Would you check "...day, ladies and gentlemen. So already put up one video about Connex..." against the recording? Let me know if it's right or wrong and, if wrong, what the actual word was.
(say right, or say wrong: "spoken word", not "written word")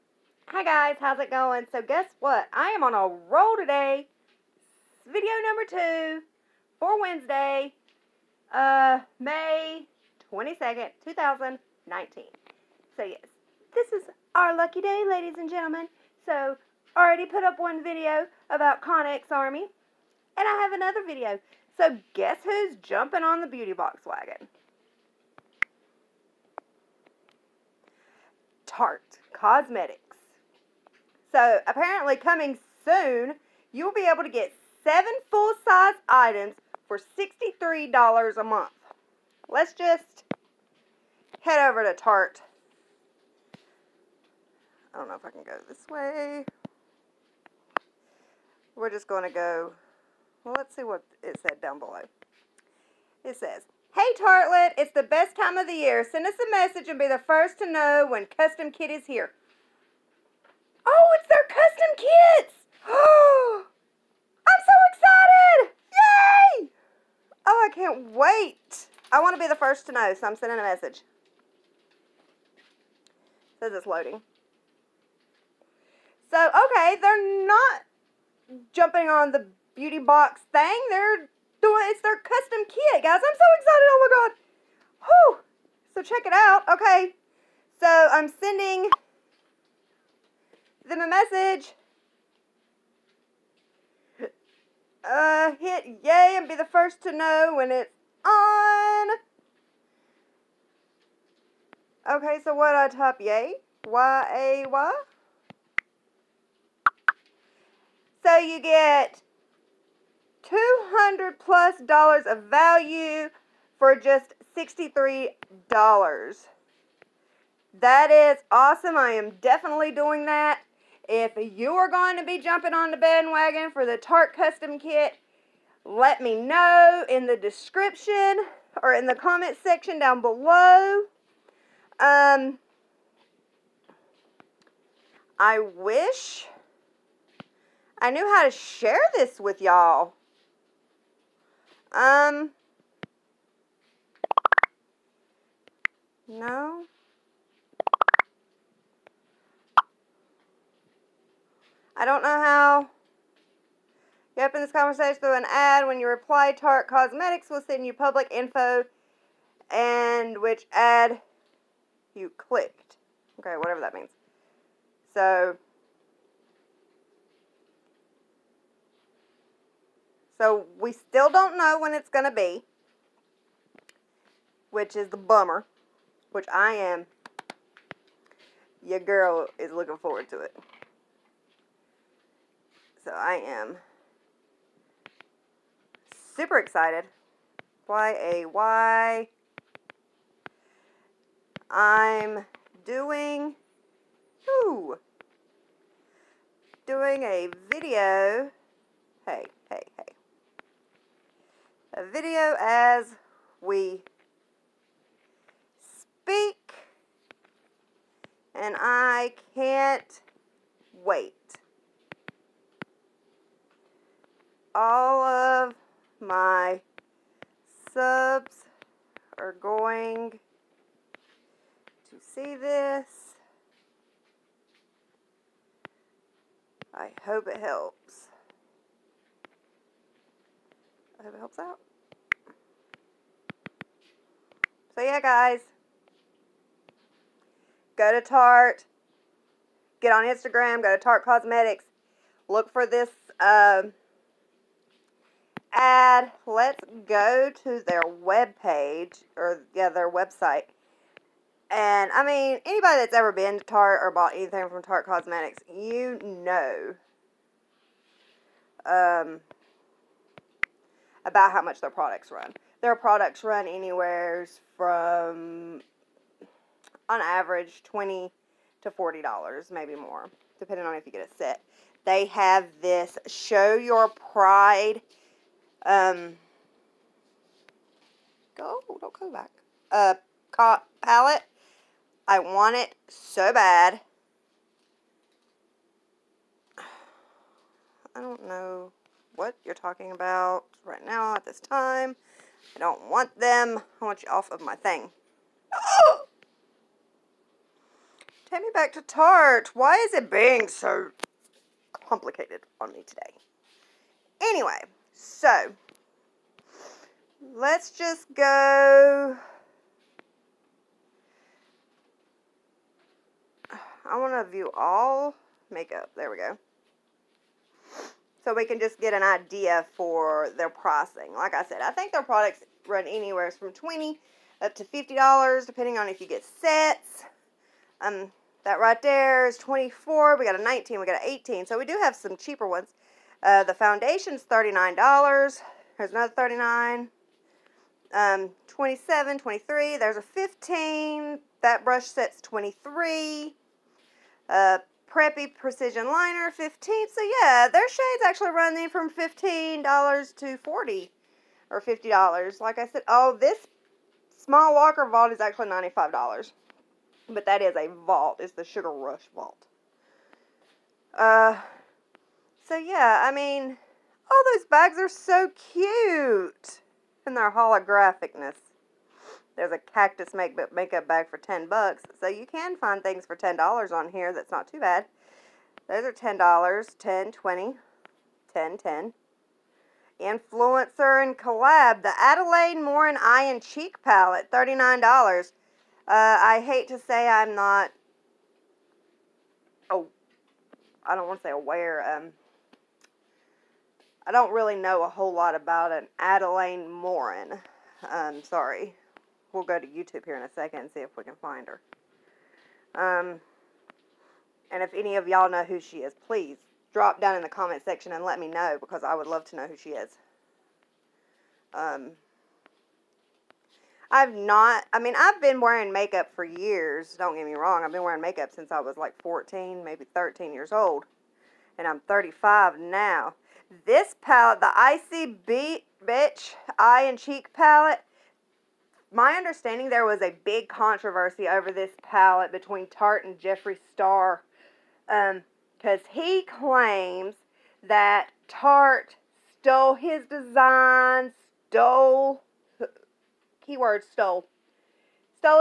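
right.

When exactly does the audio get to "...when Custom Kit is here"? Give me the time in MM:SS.
00:58.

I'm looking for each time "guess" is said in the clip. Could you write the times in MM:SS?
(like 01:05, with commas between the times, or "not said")
00:01, 00:22.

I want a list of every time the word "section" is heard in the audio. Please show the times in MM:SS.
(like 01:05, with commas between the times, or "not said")
02:09, 06:47.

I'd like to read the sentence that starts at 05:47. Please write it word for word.
So yeah, their shades actually running from $15 to 40 or $50.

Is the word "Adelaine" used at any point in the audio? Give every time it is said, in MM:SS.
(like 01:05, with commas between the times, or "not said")
06:22, 06:36.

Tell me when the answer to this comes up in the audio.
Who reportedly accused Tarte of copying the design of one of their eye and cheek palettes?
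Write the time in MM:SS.
07:13.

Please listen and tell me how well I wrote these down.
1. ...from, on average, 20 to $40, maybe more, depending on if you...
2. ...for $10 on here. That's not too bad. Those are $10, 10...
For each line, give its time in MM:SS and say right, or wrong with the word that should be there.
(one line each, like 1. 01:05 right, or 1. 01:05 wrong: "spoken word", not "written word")
1. 04:24 right
2. 06:13 right.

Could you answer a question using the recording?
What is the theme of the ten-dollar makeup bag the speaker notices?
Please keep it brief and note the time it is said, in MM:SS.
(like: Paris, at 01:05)
Cactus, at 06:09.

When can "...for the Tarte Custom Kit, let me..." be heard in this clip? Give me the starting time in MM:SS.
02:03.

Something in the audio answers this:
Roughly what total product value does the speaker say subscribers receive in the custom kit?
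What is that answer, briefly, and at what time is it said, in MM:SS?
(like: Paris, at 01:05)
200 plus dollars, at 01:50.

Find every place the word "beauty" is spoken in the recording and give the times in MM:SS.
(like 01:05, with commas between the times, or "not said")
00:23, 01:19.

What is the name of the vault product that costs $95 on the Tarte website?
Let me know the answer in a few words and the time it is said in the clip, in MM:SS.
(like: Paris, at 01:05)
Sugar Rush Vault, at 05:58.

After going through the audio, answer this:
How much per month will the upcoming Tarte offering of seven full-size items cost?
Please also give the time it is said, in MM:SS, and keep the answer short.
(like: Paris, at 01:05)
$63 a month, at 00:36.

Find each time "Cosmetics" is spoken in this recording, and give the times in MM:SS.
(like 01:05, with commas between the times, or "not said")
00:29, 02:36, 04:01, 04:15.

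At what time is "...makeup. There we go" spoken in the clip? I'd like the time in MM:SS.
05:15.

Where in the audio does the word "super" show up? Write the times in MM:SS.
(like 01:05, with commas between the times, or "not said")
03:06.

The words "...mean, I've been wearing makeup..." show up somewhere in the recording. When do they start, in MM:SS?
06:54.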